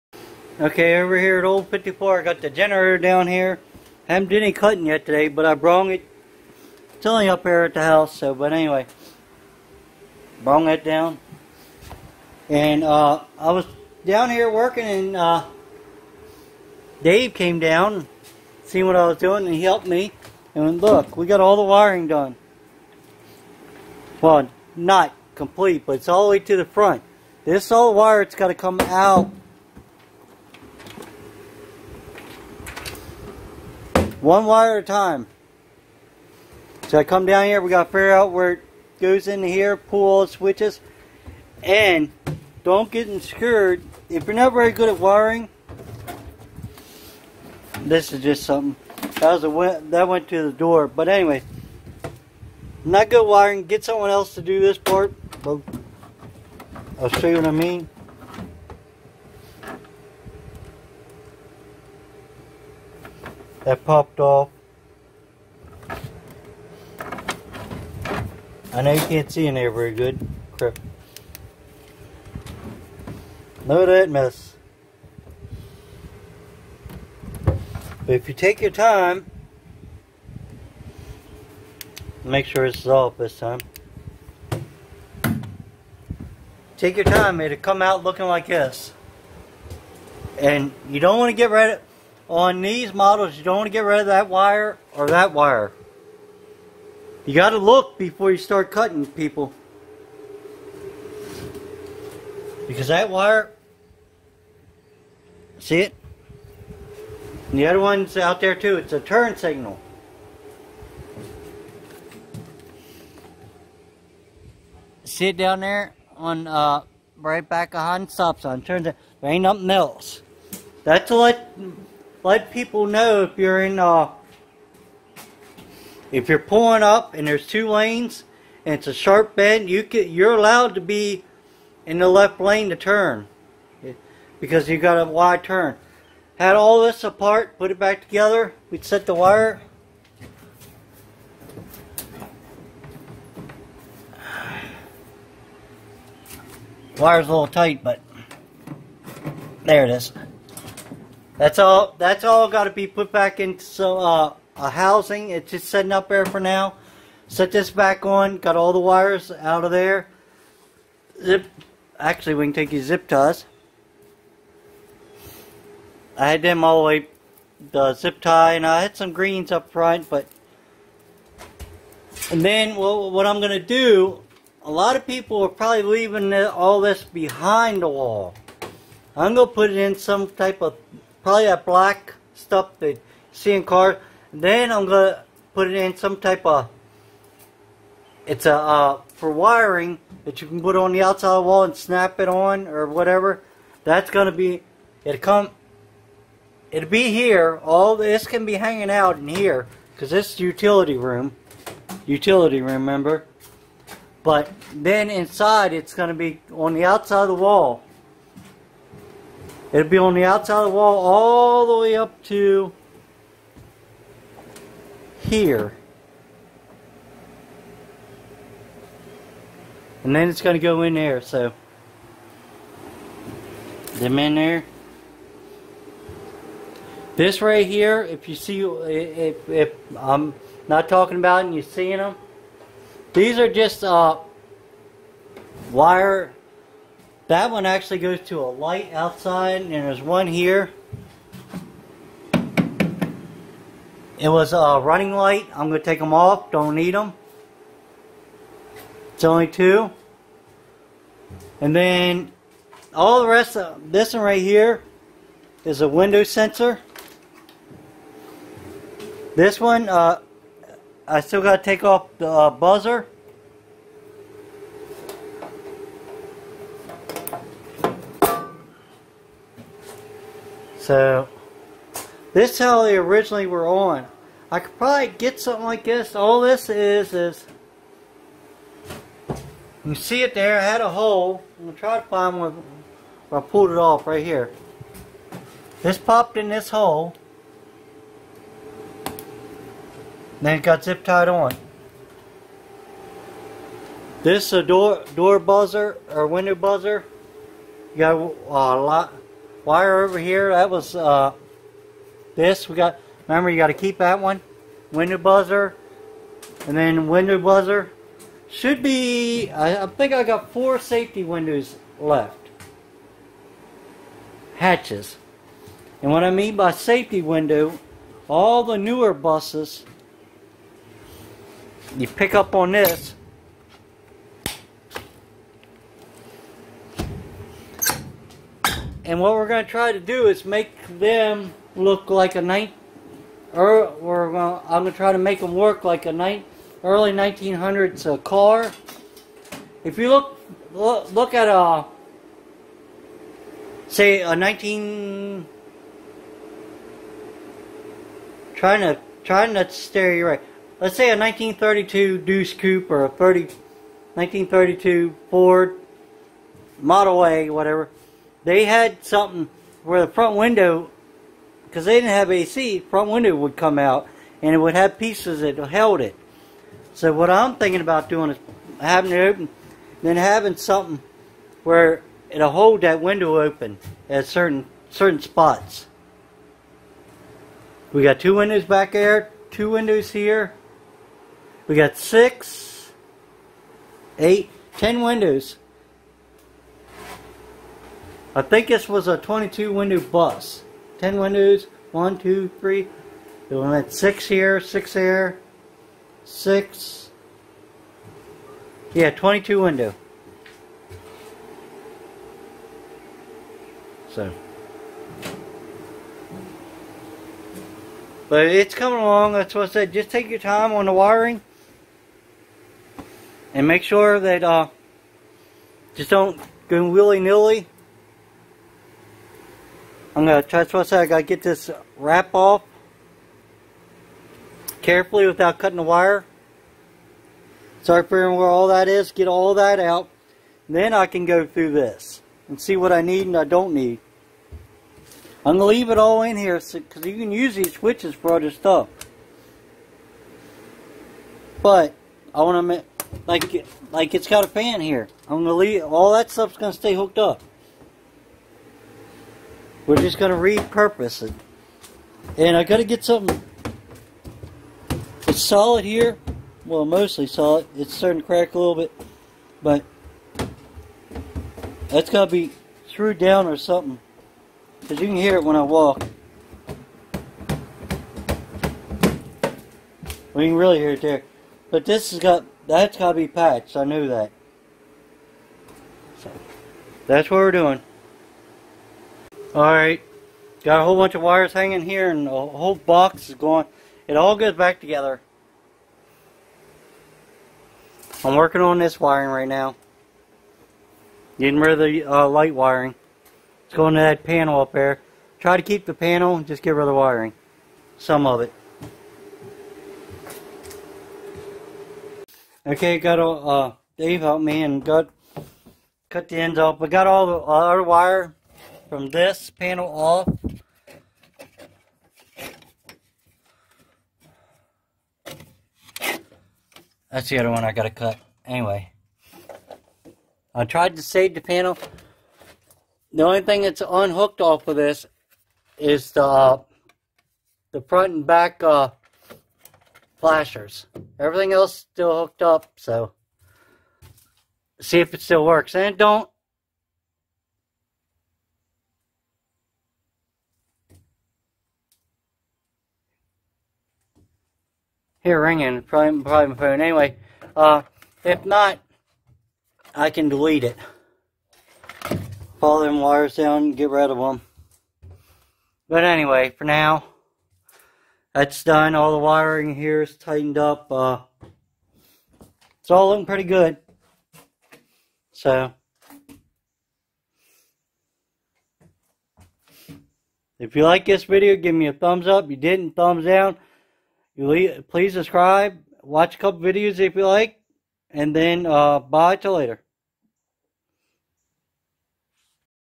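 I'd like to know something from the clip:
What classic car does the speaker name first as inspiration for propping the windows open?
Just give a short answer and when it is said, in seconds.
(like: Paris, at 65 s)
1932 Deuce Coupe, at 351 s.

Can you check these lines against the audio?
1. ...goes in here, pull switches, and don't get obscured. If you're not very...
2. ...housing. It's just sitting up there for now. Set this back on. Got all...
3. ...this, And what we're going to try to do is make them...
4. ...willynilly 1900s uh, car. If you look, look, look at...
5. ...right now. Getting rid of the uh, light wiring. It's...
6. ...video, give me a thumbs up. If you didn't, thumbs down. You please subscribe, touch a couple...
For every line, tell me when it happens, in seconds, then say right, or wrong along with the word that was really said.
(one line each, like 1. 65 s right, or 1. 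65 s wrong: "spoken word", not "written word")
1. 38 s right
2. 154 s right
3. 322 s right
4. 336 s wrong: "early", not "willynilly"
5. 489 s right
6. 571 s wrong: "watch", not "touch".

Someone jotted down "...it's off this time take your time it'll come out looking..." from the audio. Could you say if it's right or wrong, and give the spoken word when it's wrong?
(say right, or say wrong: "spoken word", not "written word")
right.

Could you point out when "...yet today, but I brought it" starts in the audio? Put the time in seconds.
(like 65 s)
4 s.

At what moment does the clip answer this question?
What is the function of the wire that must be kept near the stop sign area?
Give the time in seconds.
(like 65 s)
109 s.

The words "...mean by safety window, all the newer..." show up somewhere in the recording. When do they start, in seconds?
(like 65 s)
316 s.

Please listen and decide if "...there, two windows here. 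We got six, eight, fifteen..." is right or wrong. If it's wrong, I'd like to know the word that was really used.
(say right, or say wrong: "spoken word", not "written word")
wrong: "ten", not "fifteen".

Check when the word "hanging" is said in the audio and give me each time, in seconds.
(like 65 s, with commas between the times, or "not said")
198 s, 481 s.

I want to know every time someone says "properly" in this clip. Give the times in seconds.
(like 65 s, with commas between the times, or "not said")
not said.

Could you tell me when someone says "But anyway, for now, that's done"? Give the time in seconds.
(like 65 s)
555 s.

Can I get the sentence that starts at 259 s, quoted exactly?
This one, uh, I still got to take off the uh, buzzer.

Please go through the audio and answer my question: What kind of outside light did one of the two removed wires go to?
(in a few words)
running light.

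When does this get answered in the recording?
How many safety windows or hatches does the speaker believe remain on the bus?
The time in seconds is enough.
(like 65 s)
310 s.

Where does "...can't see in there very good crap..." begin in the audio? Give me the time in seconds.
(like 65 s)
69 s.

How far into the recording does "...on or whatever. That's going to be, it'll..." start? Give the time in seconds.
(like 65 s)
192 s.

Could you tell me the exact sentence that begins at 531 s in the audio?
Everything else still hooked up, so see if it still works.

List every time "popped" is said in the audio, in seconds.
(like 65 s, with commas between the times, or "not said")
63 s, 285 s.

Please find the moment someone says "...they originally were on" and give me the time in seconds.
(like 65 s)
272 s.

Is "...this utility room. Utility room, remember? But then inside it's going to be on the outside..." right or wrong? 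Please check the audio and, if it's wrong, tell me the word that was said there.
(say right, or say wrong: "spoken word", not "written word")
right.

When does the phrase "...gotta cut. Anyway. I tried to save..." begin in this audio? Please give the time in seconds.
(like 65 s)
517 s.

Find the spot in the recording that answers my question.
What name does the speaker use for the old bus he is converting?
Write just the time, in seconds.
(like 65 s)
1 s.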